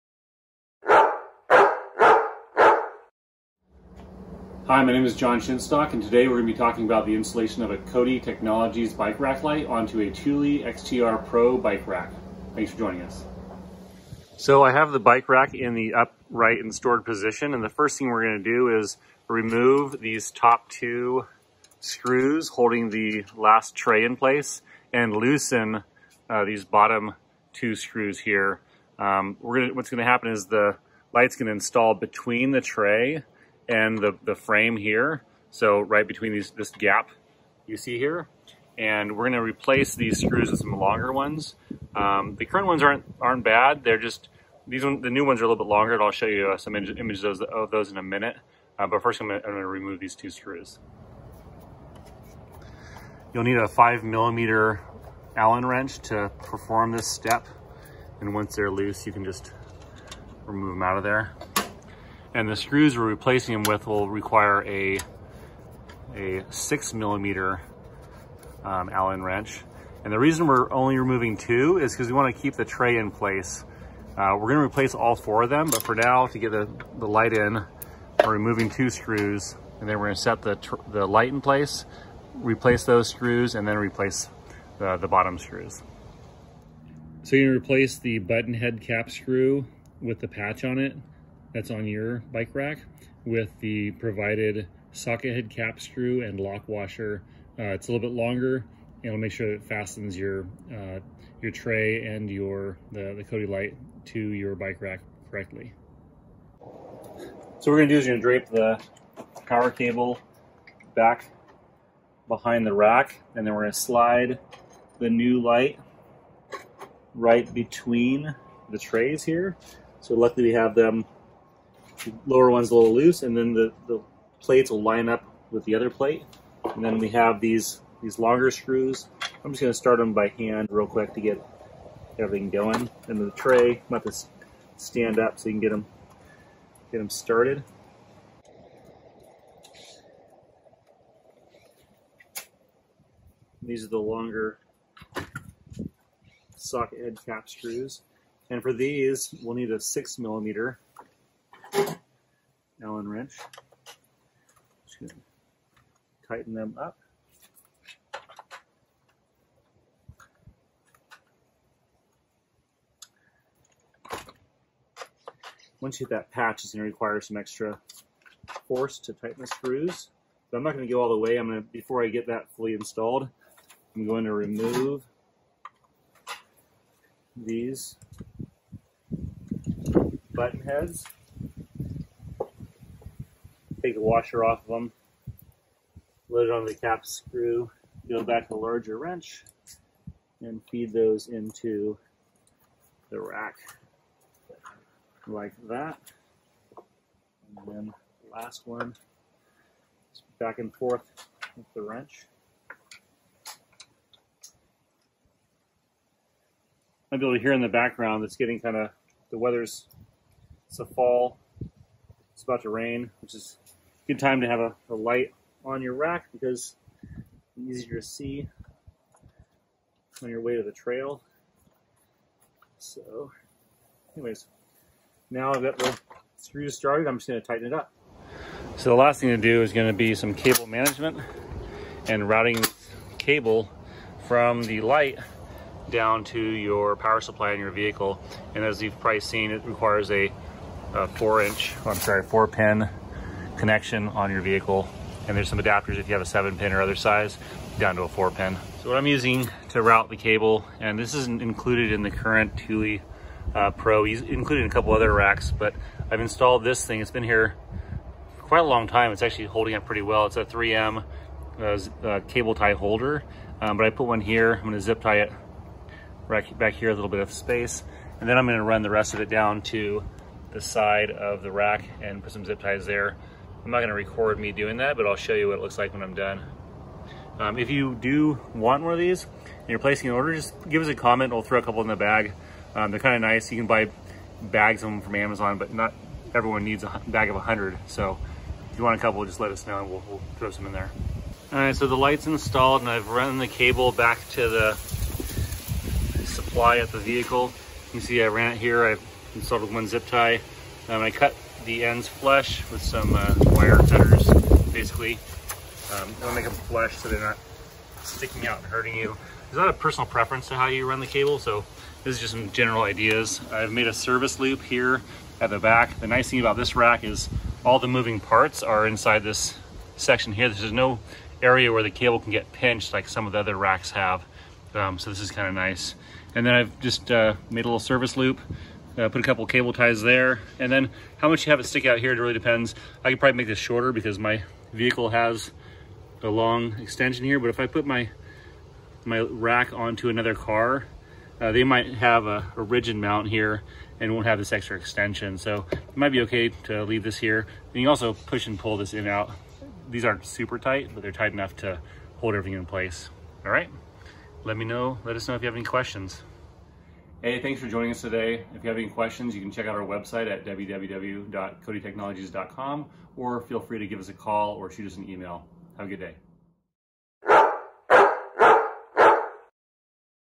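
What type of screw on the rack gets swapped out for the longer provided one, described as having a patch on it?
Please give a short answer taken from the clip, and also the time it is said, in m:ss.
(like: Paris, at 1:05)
button head cap screw, at 1:28.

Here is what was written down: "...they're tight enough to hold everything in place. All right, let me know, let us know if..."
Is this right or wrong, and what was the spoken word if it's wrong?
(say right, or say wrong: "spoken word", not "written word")
right.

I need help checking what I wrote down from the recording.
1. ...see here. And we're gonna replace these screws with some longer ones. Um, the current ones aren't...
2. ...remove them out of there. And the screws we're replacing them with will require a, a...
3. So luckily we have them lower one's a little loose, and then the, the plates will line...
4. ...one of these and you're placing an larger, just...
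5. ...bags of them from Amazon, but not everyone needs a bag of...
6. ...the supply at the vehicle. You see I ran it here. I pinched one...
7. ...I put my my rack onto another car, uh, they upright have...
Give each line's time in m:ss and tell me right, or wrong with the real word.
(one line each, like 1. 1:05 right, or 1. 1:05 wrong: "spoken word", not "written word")
1. 0:37 right
2. 1:00 right
3. 1:59 right
4. 4:38 wrong: "order", not "larger"
5. 4:44 right
6. 4:54 wrong: "installed", not "pinched"
7. 5:37 wrong: "might", not "upright".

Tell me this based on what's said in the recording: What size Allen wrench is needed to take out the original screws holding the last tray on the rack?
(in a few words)
5 millimeter.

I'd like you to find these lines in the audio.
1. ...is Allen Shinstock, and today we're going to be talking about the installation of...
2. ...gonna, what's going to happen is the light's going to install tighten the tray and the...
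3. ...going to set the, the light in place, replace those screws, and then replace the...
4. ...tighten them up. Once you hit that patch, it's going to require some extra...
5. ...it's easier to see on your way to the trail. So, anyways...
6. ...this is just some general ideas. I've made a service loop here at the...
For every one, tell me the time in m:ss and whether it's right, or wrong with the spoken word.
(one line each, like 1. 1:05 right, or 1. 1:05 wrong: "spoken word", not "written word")
1. 0:05 wrong: "John", not "Allen"
2. 0:29 wrong: "between", not "tighten"
3. 1:20 right
4. 2:36 right
5. 3:37 right
6. 5:12 right.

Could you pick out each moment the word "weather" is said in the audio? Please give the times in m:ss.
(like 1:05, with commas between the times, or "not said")
3:29.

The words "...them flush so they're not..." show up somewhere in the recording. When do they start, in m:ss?
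5:06.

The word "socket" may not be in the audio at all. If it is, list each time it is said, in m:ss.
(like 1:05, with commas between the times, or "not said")
1:34, 2:26.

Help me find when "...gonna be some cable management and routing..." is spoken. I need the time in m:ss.
3:49.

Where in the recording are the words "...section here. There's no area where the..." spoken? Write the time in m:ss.
5:19.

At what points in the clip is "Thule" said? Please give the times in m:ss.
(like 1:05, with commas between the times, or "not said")
0:10, 4:12.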